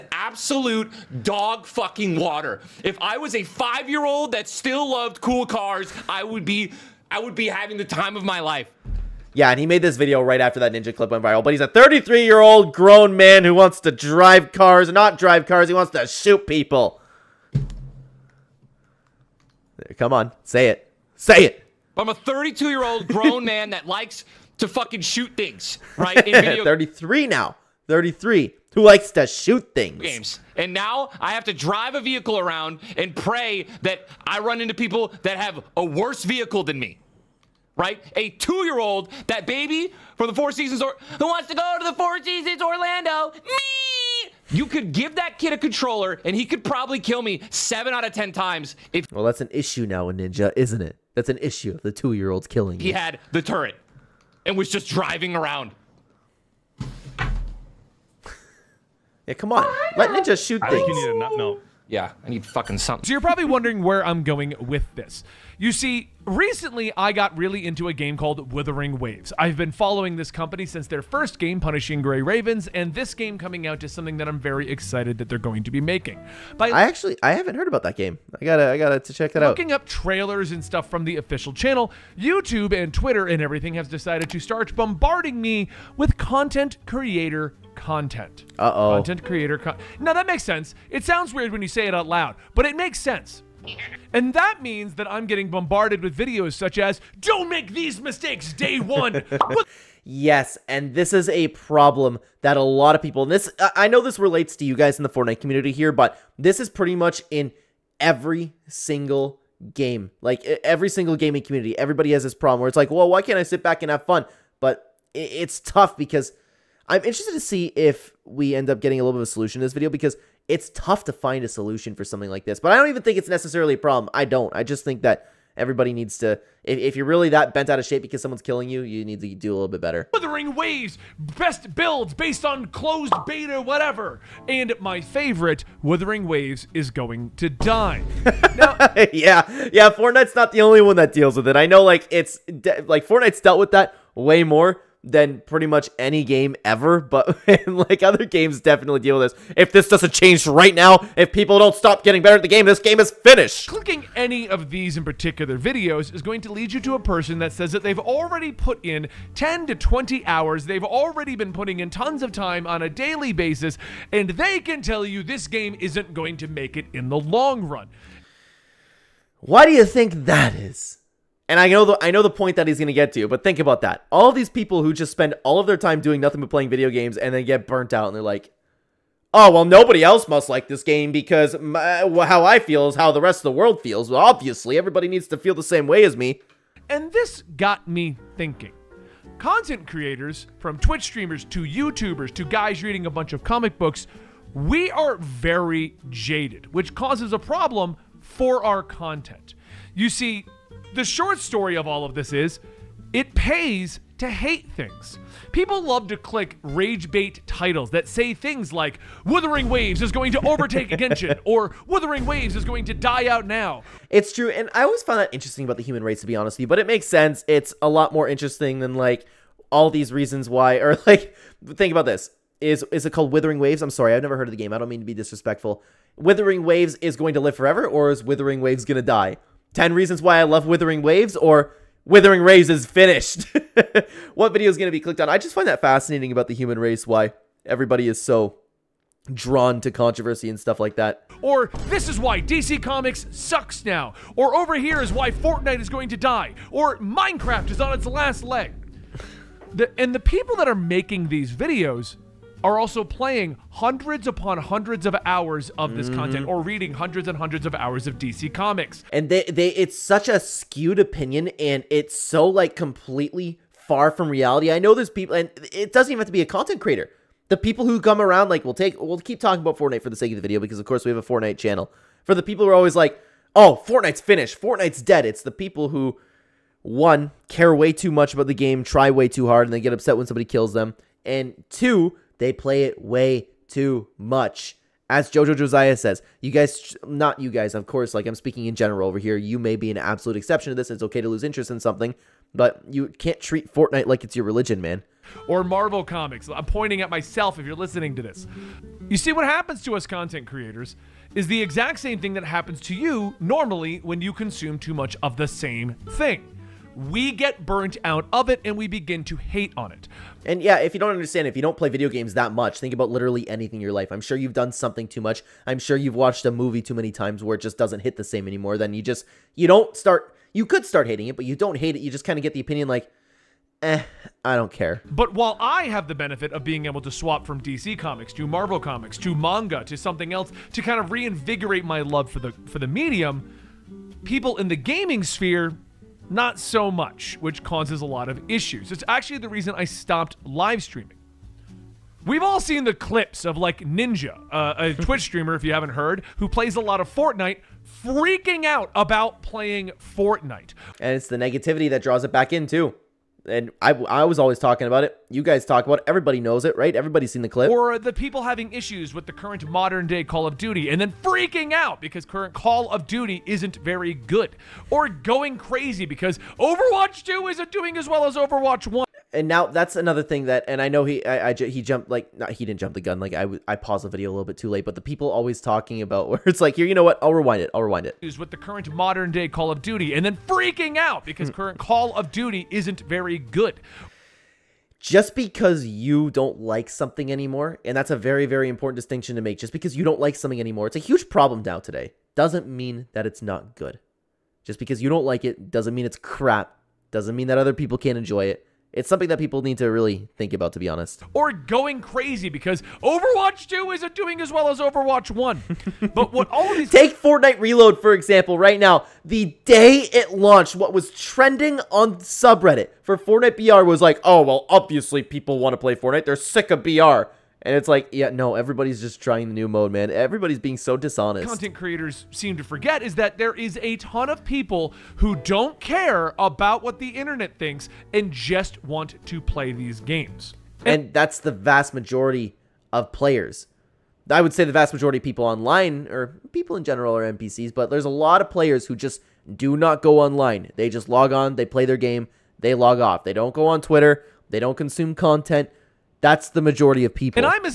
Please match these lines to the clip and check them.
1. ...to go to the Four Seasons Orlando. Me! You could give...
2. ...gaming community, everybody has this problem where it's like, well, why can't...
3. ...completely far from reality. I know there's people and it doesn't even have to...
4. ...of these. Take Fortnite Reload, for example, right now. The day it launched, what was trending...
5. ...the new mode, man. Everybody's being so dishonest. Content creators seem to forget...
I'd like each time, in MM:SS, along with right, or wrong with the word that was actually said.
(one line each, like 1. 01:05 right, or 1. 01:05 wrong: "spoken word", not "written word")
1. 00:41 right
2. 01:51 right
3. 04:22 right
4. 06:46 right
5. 06:59 right.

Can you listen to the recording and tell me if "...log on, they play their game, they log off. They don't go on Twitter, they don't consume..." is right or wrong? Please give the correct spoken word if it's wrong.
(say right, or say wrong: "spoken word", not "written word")
right.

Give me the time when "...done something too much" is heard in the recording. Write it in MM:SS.
05:14.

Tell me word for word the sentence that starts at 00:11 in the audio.
But he's a 33 year old grown man who wants to drive cars, not drive cars.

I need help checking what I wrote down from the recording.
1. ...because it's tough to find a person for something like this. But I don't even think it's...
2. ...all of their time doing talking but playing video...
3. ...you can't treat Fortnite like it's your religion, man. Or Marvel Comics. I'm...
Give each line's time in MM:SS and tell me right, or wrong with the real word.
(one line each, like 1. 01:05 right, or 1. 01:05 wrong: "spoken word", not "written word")
1. 01:59 wrong: "solution", not "person"
2. 02:55 wrong: "nothing", not "talking"
3. 04:52 right.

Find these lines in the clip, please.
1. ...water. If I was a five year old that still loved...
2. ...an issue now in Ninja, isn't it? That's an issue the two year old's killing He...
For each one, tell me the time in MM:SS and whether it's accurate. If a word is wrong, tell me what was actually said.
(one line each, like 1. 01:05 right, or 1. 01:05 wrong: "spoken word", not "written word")
1. 00:02 right
2. 00:49 right.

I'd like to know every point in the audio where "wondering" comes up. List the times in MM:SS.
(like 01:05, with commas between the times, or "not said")
01:03.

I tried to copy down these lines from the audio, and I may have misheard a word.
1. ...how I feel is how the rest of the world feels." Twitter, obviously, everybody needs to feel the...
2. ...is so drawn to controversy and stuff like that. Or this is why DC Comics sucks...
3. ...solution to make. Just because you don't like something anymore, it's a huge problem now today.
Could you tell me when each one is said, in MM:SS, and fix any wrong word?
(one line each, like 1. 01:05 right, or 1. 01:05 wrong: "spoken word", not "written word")
1. 03:02 wrong: "Well", not "Twitter"
2. 03:58 right
3. 06:28 wrong: "distinction", not "solution".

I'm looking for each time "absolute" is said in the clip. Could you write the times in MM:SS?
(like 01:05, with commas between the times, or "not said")
00:00, 04:49.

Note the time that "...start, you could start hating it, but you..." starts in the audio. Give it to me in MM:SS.
05:19.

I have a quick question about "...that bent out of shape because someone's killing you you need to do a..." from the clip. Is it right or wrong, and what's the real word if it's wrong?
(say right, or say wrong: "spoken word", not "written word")
right.